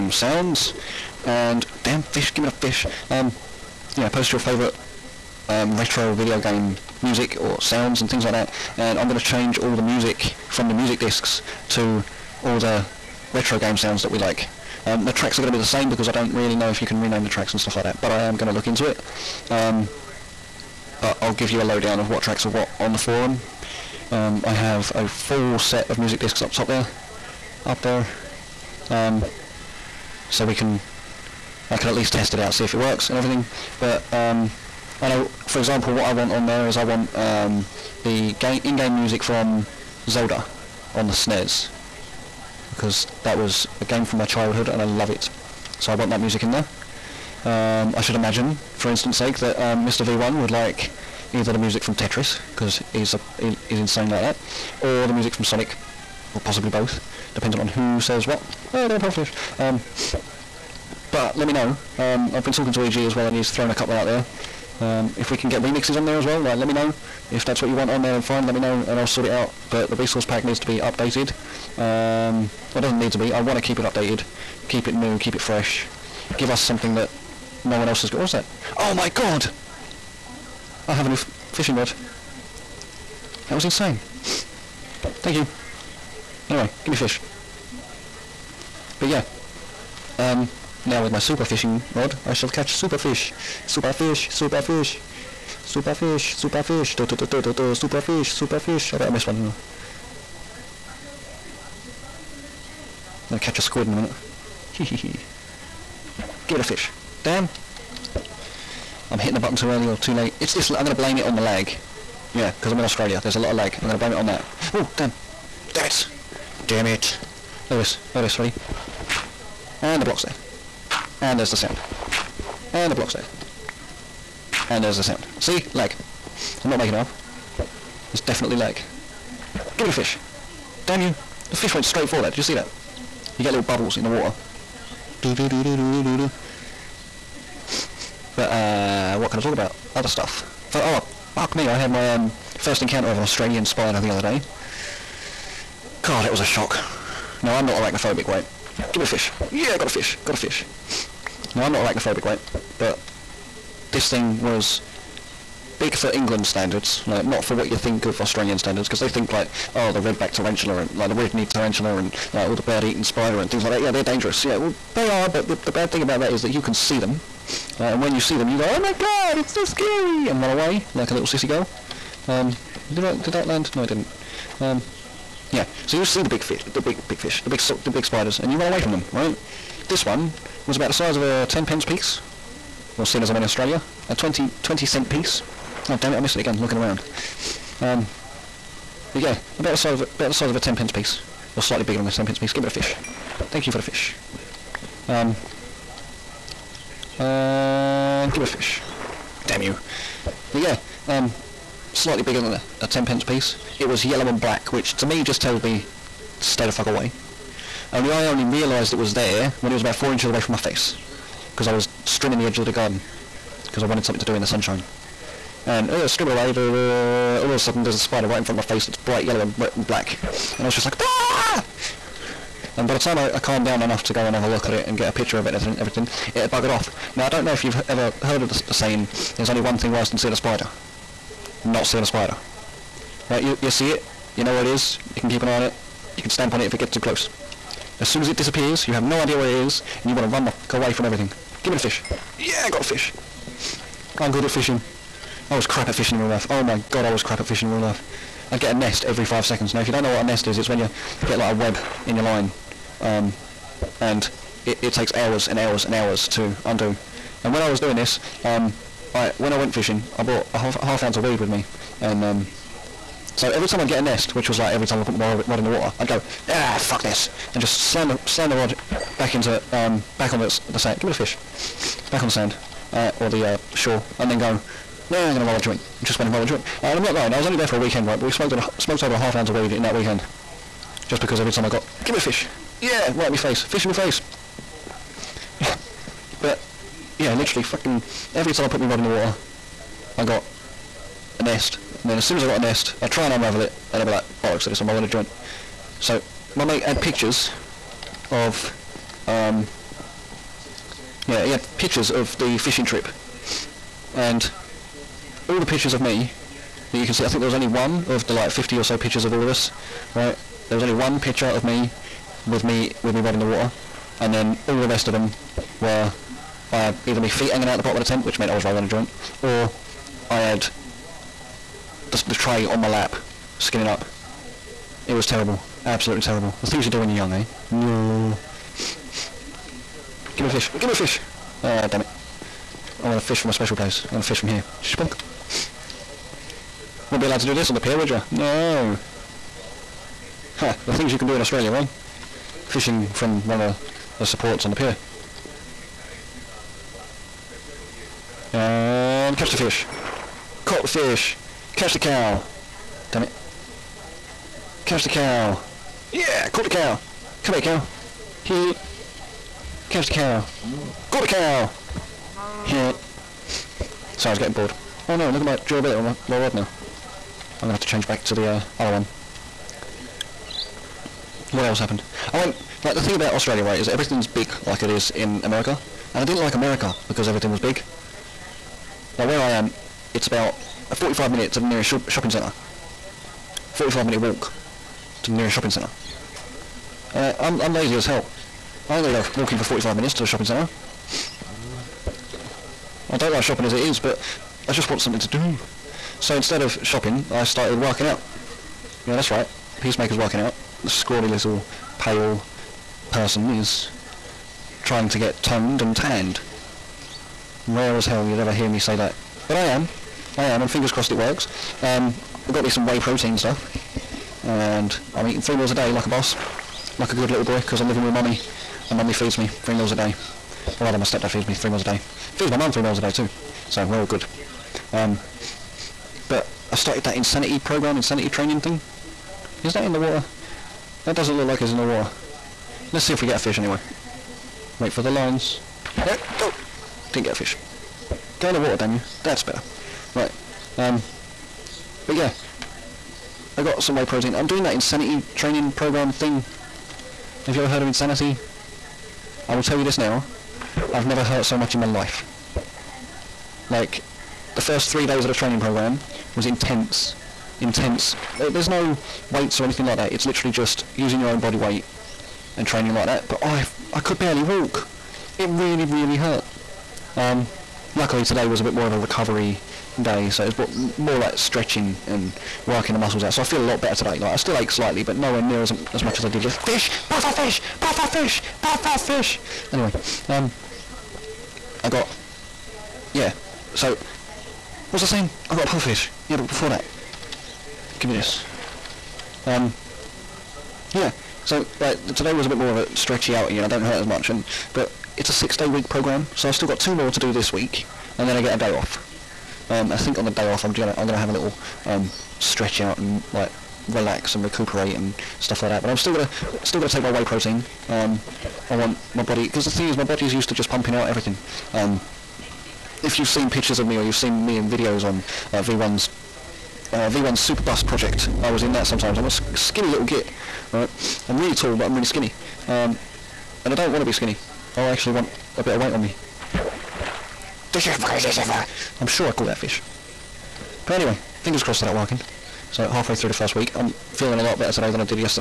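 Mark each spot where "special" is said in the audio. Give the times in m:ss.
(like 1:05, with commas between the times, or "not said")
5:33.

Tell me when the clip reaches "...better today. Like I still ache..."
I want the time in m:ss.
7:53.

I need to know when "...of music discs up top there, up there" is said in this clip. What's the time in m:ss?
0:25.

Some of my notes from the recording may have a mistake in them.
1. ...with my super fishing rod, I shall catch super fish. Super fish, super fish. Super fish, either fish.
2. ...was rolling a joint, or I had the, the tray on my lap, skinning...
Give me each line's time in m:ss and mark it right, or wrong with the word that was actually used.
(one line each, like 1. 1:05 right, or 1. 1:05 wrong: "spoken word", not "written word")
1. 1:31 wrong: "super", not "either"
2. 5:18 right.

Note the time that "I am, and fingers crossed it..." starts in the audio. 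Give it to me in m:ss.
6:50.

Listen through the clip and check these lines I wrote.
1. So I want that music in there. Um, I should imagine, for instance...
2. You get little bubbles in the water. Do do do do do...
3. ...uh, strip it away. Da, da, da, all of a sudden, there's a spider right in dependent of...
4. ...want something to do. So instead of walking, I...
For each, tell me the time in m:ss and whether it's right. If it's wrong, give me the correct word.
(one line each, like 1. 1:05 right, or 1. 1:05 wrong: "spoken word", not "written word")
1. 0:45 right
2. 2:13 right
3. 3:35 wrong: "front", not "dependent"
4. 6:34 wrong: "shopping", not "walking".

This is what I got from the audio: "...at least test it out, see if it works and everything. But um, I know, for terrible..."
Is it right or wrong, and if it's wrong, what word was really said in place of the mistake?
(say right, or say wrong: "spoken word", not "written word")
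wrong: "example", not "terrible".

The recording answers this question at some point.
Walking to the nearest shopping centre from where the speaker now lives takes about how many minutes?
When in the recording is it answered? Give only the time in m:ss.
6:23.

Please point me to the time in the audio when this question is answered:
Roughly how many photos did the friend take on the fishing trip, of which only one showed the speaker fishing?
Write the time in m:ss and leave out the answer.
5:08.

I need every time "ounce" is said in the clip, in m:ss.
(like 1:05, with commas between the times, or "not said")
4:21, 4:39.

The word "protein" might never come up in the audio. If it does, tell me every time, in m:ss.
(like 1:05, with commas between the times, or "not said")
6:52, 7:24, 8:27.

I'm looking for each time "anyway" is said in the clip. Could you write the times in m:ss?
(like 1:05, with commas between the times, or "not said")
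1:26, 7:13, 7:59, 8:50.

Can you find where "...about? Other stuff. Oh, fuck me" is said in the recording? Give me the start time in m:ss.
2:19.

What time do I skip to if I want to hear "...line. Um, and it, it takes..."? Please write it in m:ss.
4:12.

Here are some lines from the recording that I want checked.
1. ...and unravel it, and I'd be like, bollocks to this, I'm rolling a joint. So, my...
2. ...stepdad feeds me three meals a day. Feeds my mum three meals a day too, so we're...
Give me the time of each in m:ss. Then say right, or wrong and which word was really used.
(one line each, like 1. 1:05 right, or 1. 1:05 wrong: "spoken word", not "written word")
1. 4:53 right
2. 7:01 right.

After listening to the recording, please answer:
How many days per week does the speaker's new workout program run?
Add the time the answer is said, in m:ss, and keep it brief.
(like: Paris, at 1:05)
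6, at 8:15.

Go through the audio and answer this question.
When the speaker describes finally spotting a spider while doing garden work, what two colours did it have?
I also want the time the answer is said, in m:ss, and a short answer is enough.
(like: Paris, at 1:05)
Yellow and black, at 3:24.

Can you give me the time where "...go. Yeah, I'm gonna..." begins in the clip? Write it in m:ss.
4:34.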